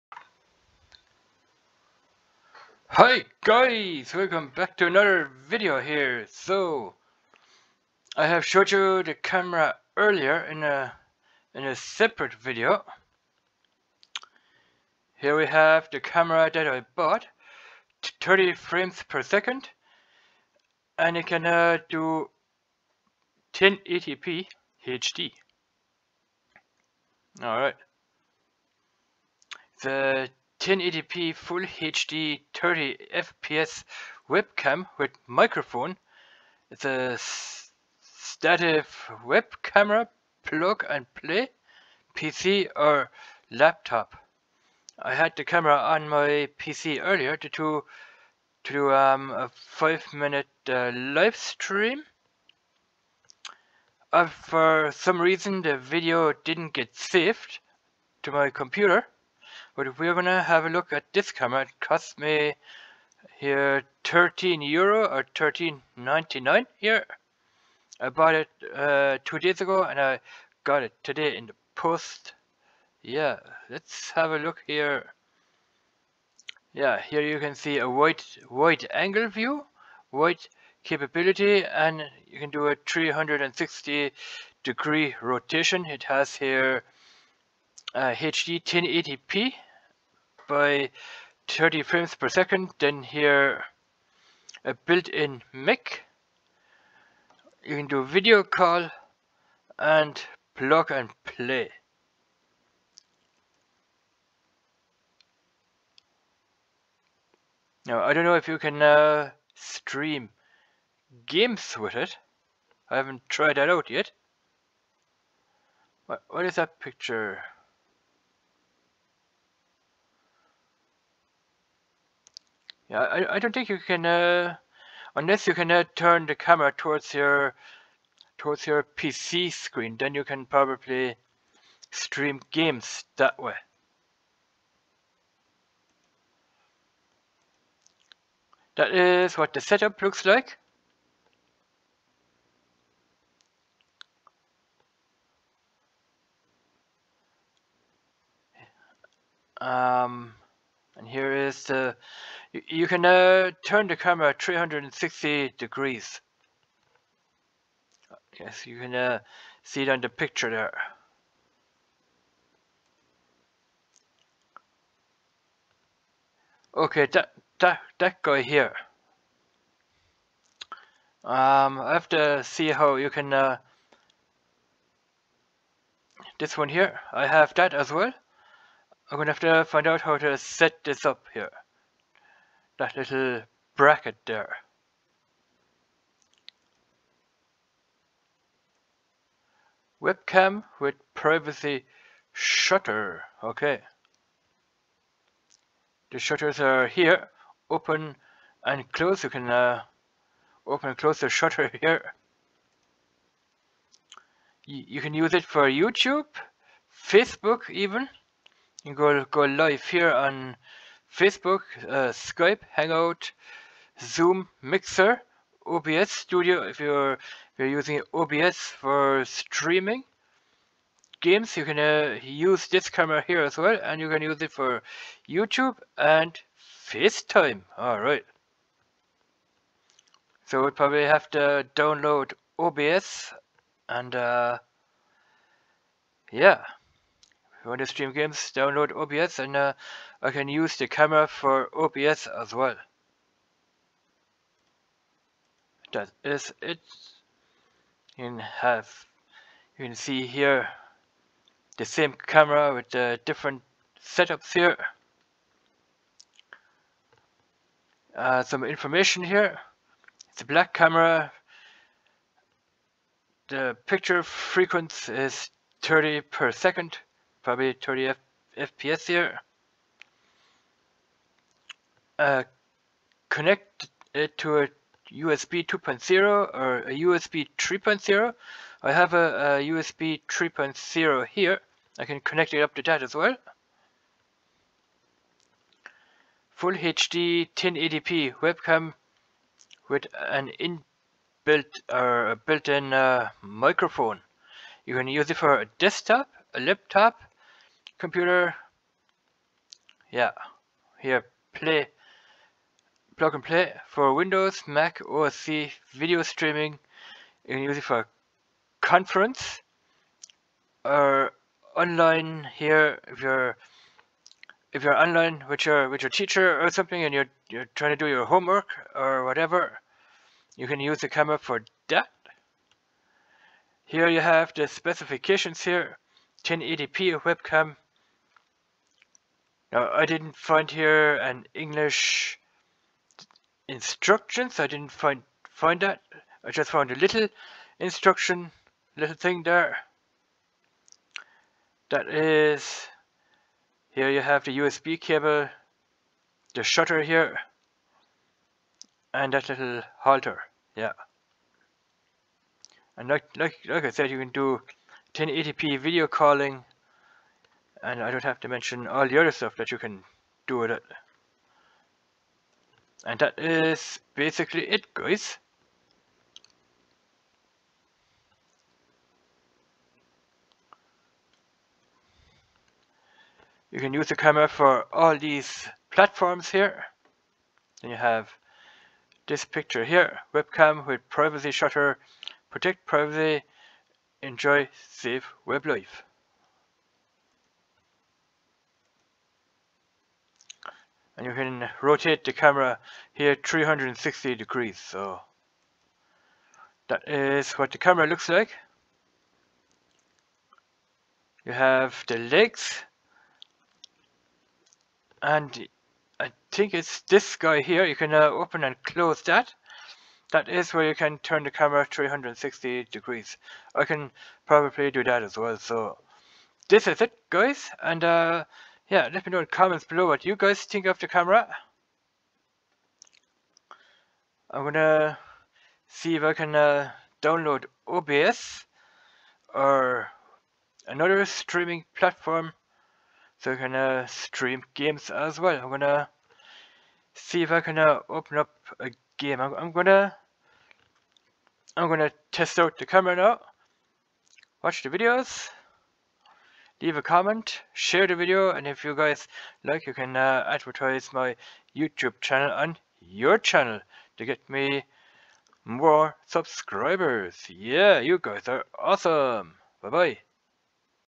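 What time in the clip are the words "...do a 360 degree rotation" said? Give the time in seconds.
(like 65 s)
82 s.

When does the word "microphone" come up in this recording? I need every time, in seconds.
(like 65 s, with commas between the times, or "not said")
35 s, 293 s.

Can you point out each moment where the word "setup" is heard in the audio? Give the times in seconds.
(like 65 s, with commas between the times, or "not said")
139 s, 254 s.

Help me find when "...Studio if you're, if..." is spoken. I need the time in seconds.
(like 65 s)
216 s.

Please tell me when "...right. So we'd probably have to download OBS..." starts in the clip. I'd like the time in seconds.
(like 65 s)
227 s.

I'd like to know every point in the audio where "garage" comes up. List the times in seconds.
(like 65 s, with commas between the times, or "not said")
not said.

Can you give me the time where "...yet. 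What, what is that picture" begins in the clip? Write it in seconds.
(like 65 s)
113 s.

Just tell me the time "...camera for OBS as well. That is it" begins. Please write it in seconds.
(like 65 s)
240 s.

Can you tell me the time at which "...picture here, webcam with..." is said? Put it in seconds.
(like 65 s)
379 s.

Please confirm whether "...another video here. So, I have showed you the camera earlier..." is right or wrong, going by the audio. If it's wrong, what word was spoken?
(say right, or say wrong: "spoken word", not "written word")
right.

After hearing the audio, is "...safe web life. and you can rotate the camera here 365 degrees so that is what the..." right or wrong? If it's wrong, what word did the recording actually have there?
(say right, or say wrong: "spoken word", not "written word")
wrong: "360", not "365".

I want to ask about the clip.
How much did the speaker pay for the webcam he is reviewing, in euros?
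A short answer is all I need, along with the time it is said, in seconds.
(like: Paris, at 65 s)
13.99, at 65 s.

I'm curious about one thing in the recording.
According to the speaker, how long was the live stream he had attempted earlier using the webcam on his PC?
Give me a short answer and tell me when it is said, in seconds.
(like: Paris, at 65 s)
5 minutes, at 49 s.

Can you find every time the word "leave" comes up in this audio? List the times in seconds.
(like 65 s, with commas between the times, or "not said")
446 s.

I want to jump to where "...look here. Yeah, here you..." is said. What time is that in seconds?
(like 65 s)
74 s.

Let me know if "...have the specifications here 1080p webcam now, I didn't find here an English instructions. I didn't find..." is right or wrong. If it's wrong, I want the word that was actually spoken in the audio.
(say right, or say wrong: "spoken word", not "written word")
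right.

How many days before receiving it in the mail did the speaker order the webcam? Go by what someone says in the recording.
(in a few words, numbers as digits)
2.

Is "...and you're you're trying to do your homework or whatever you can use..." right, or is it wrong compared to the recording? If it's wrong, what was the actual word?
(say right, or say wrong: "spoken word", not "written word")
right.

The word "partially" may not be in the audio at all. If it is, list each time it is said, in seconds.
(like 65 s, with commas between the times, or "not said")
not said.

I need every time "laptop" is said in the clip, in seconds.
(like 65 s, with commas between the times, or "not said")
43 s, 296 s.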